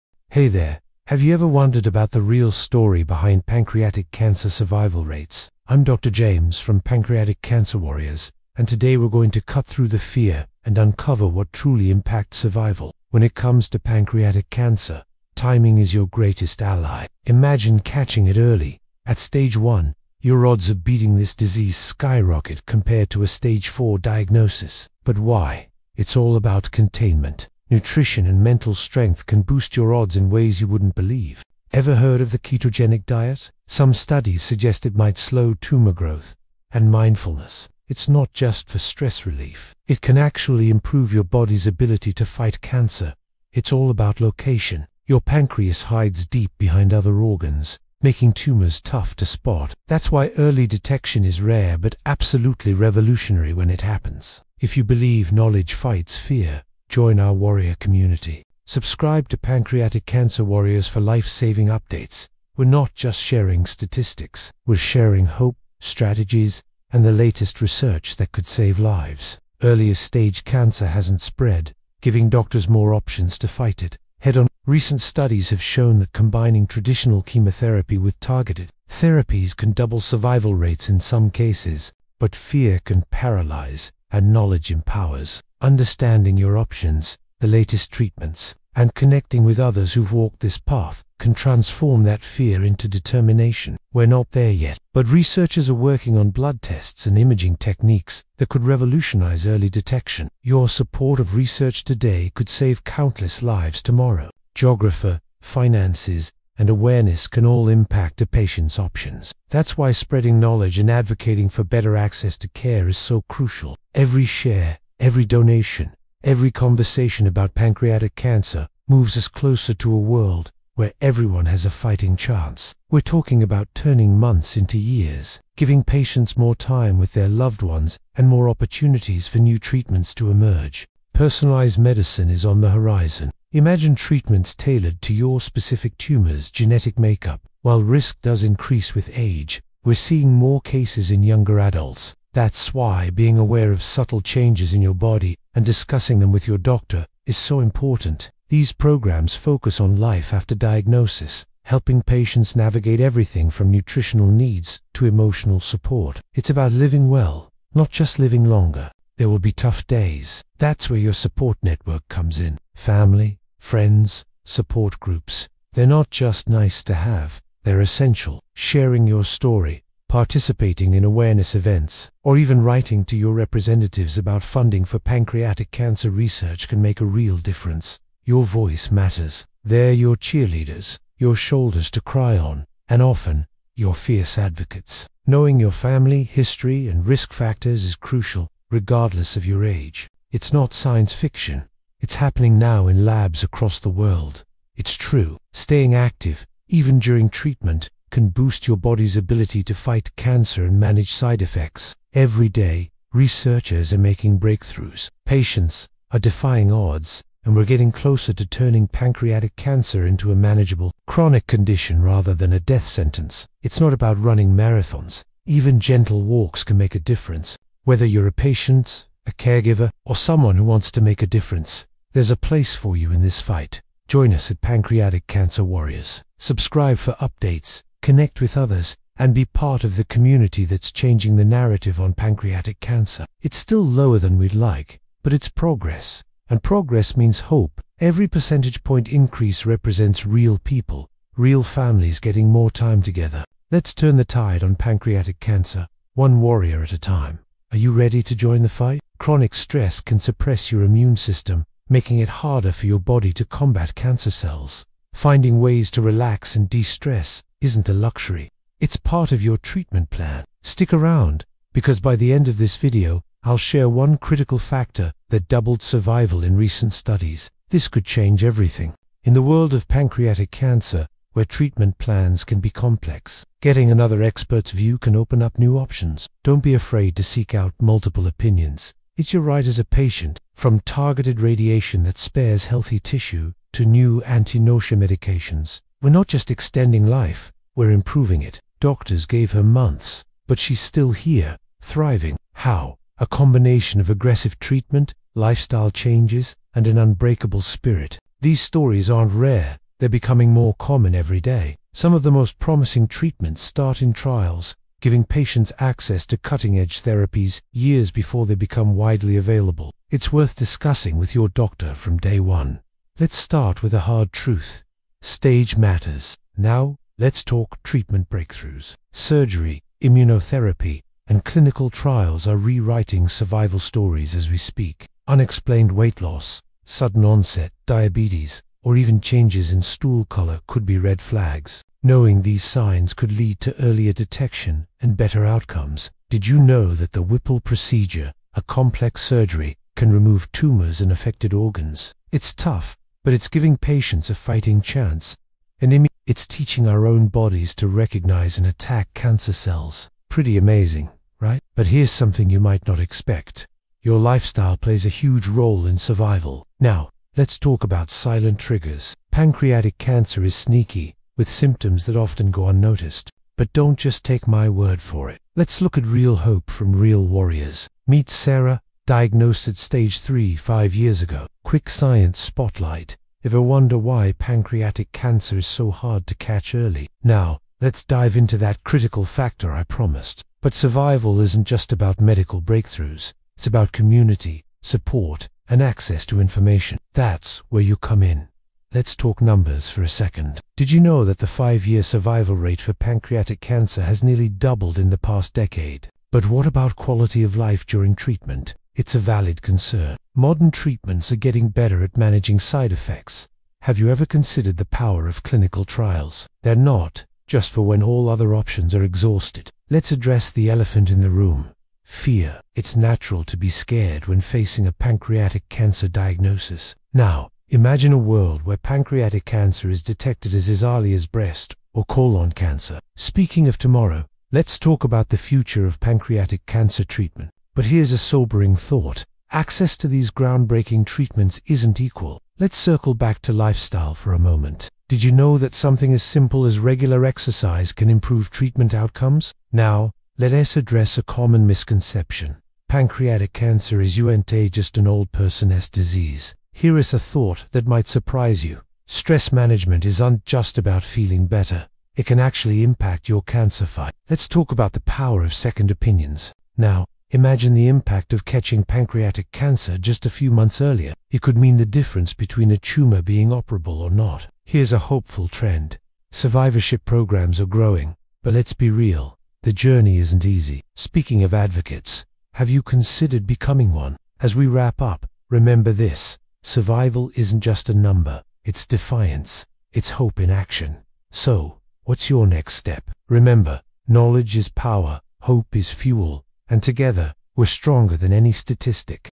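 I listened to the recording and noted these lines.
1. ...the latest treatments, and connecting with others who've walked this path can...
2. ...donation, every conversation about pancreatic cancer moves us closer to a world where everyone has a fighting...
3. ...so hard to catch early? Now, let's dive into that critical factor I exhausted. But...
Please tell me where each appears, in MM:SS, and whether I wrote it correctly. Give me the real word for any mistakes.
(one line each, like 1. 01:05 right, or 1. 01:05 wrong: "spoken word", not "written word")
1. 01:27 right
2. 01:55 right
3. 06:15 wrong: "promised", not "exhausted".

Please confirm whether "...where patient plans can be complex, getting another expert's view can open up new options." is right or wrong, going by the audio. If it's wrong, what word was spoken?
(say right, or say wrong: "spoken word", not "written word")
wrong: "treatment", not "patient".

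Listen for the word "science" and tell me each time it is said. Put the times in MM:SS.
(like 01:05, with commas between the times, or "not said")
03:10, 06:11.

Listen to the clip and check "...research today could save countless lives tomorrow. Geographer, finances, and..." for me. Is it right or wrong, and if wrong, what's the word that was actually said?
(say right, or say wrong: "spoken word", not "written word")
right.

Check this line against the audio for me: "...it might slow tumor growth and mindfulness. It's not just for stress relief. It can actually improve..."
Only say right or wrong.
right.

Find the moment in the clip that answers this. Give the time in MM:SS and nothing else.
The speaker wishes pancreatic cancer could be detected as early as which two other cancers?
07:01.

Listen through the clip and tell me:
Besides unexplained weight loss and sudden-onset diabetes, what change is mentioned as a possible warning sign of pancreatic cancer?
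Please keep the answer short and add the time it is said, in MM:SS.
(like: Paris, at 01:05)
Changes in stool color, at 05:29.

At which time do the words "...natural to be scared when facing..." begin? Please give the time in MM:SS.
06:52.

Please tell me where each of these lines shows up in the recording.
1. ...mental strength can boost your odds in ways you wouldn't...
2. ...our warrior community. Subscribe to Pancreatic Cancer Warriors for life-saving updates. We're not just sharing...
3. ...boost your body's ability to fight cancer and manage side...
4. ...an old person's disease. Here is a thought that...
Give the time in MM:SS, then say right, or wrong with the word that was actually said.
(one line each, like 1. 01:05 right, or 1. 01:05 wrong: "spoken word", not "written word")
1. 00:28 right
2. 00:57 right
3. 03:18 right
4. 07:24 right.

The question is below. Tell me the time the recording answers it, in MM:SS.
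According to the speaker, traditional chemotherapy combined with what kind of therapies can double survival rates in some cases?
01:18.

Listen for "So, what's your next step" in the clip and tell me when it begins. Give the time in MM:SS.
08:01.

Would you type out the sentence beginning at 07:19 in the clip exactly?
Now, let us address a common misconception.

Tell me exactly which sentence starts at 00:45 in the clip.
Your pancreas hides deep behind other organs, making tumors tough to spot.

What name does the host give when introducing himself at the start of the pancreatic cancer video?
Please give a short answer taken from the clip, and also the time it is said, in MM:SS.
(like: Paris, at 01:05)
Dr. James, at 00:05.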